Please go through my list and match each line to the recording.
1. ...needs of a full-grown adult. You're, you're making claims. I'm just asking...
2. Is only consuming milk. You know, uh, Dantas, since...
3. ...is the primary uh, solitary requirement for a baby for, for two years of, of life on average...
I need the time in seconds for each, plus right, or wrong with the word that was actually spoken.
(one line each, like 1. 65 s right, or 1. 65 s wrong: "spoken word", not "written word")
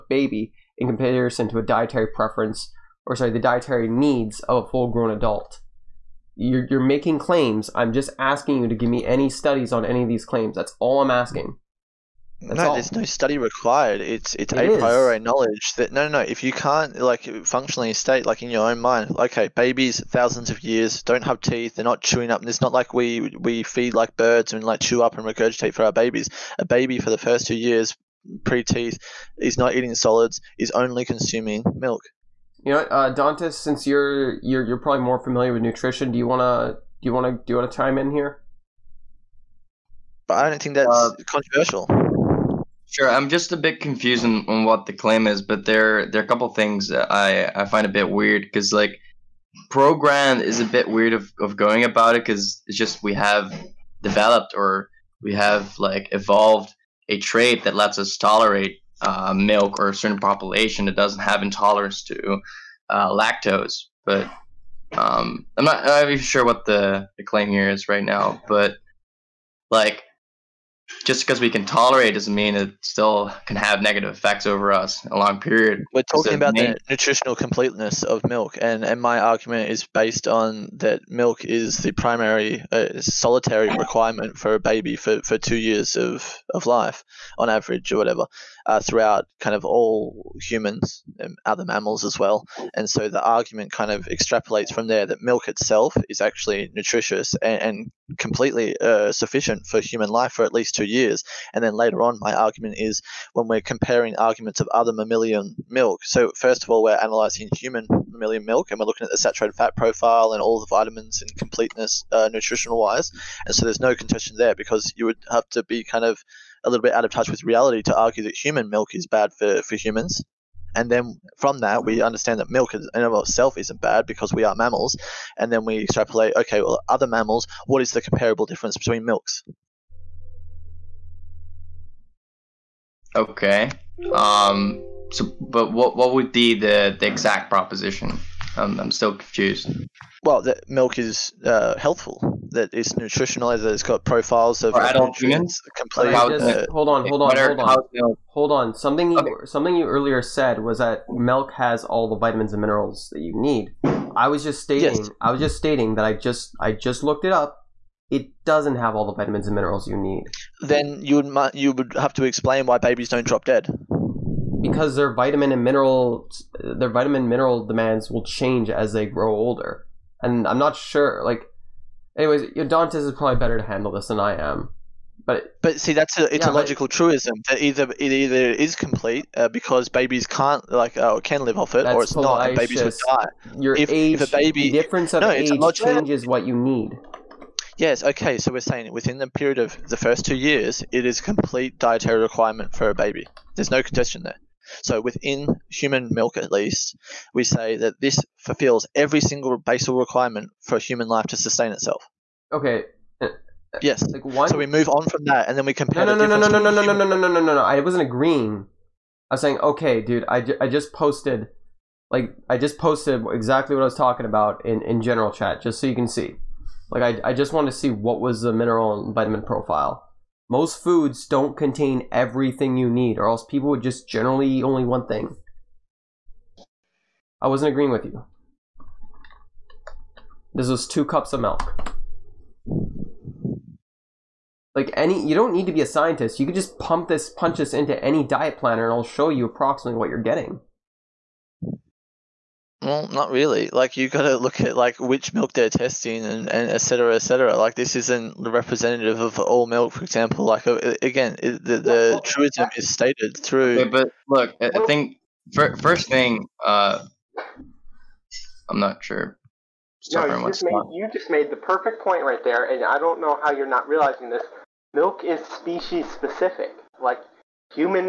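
1. 3 s right
2. 30 s right
3. 81 s right.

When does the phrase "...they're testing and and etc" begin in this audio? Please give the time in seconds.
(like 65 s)
245 s.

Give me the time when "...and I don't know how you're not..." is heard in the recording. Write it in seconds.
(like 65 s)
262 s.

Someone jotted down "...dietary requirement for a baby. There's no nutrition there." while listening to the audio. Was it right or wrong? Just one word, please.
wrong.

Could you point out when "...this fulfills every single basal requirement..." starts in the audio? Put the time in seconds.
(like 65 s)
198 s.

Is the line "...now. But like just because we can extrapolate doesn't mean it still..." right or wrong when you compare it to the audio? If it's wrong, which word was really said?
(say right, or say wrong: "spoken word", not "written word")
wrong: "tolerate", not "extrapolate".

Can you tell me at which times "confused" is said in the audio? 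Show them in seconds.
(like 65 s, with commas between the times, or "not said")
43 s, 139 s.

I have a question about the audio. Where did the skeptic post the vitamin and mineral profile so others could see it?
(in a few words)
general chat.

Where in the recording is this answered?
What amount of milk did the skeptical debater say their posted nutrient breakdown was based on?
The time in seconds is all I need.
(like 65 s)
230 s.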